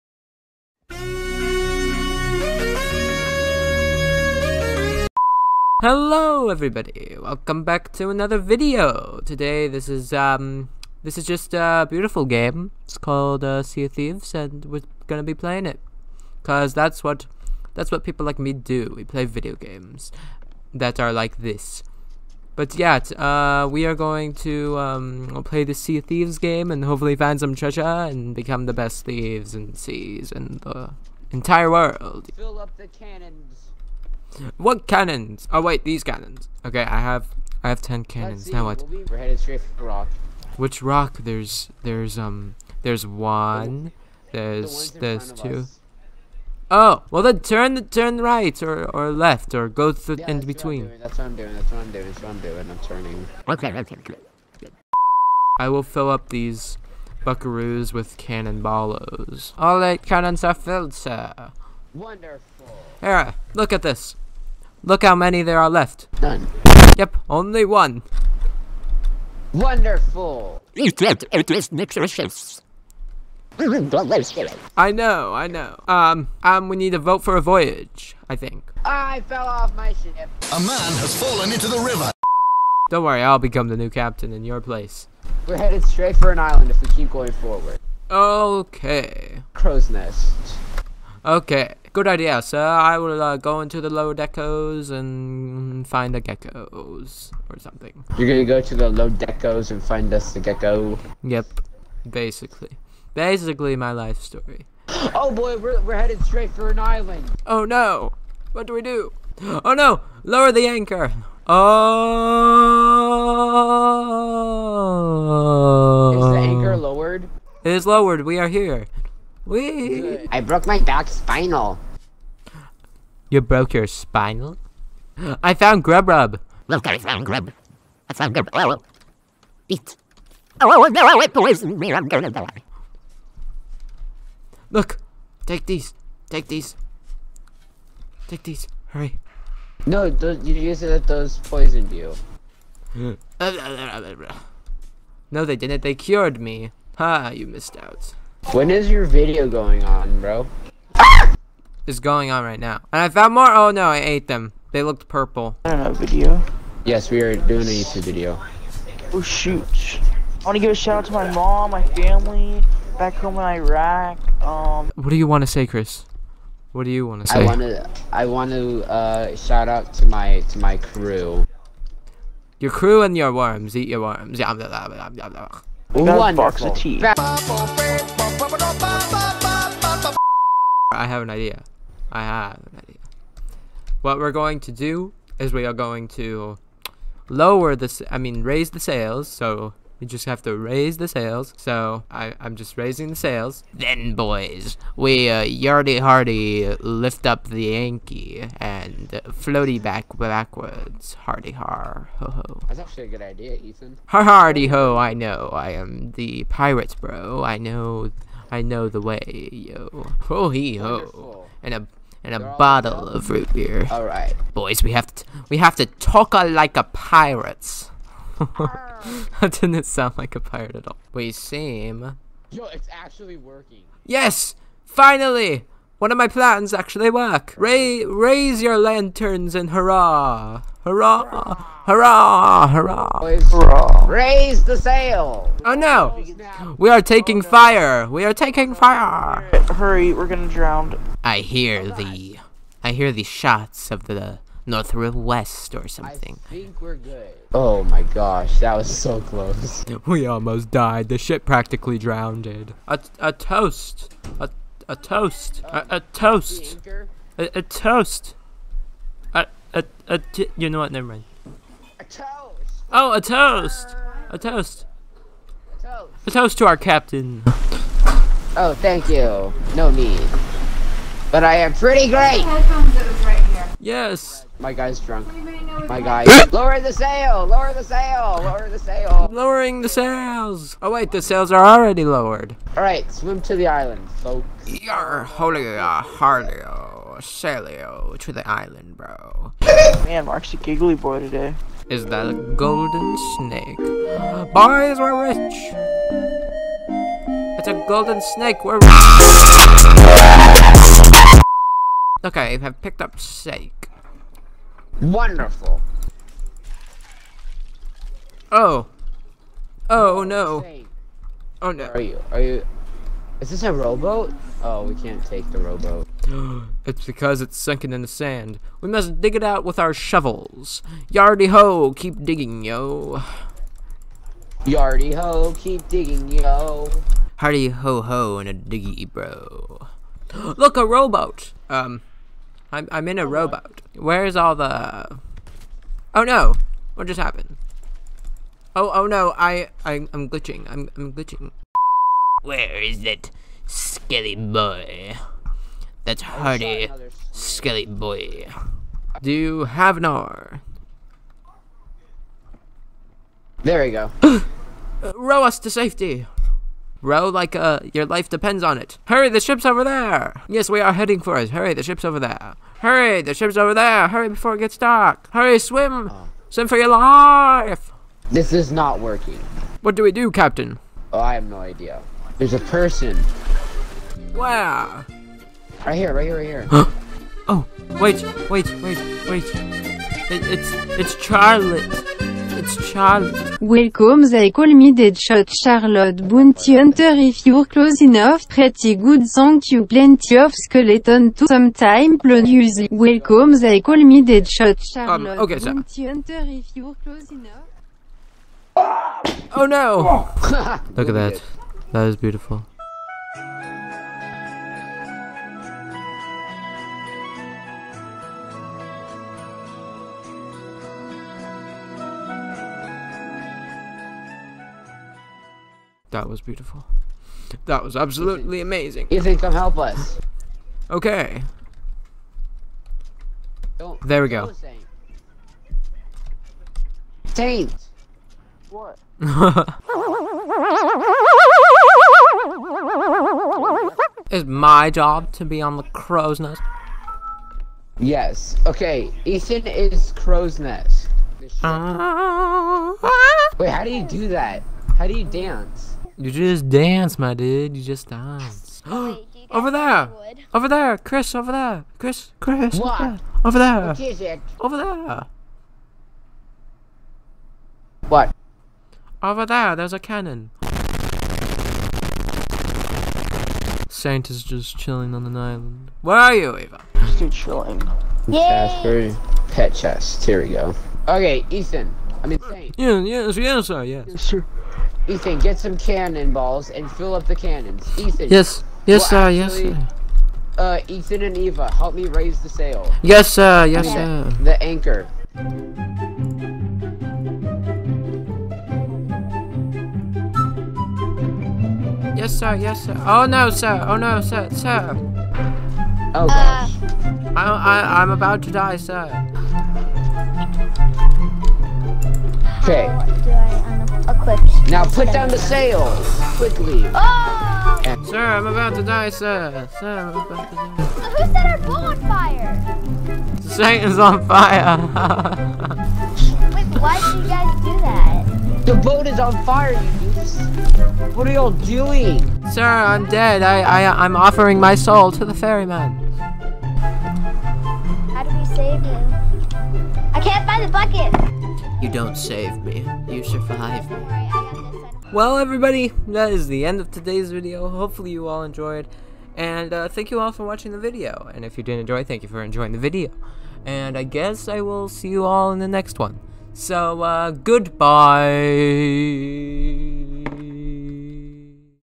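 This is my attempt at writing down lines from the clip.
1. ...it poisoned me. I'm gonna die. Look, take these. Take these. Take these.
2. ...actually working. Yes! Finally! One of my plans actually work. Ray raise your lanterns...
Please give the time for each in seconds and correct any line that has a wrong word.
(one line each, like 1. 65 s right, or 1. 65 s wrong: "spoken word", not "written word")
1. 131 s right
2. 222 s right.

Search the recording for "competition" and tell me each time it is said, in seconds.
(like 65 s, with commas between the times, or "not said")
not said.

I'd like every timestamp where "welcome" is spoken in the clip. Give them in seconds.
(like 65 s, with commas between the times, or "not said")
7 s, 383 s, 393 s.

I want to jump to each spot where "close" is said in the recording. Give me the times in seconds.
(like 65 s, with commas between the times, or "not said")
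249 s, 387 s, 397 s.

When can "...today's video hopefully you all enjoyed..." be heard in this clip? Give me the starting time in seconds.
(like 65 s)
536 s.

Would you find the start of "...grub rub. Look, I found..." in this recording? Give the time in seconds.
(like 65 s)
125 s.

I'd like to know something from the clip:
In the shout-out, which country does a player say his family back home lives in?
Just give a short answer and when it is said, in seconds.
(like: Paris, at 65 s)
Iraq, at 163 s.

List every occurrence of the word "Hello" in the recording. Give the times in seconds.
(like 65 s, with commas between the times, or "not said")
5 s.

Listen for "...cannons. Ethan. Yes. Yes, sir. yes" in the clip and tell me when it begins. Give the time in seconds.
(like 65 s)
477 s.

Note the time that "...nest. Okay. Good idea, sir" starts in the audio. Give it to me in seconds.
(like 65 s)
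89 s.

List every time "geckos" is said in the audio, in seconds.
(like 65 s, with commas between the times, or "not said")
96 s, 100 s.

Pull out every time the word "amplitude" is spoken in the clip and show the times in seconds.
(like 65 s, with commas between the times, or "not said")
not said.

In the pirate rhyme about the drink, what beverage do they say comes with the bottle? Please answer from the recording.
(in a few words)
root beer.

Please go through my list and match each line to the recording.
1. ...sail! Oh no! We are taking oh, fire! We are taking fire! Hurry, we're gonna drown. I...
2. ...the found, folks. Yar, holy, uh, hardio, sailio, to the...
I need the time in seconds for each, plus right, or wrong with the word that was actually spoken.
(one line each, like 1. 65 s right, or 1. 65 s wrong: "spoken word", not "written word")
1. 234 s right
2. 283 s wrong: "island", not "found".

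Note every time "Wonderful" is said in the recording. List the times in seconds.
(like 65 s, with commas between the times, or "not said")
61 s, 69 s, 305 s.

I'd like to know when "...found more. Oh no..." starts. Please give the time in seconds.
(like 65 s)
153 s.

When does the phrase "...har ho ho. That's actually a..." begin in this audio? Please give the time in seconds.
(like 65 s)
201 s.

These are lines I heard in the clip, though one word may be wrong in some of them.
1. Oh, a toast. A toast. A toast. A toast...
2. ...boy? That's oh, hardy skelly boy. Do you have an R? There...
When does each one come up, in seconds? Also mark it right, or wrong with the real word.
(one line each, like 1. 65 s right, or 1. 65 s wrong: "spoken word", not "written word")
1. 262 s right
2. 344 s right.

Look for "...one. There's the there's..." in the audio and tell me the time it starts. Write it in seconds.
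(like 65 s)
43 s.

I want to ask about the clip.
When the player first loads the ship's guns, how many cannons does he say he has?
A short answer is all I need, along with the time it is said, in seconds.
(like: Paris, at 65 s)
10, at 37 s.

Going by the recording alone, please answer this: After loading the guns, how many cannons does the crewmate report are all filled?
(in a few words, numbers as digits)
8.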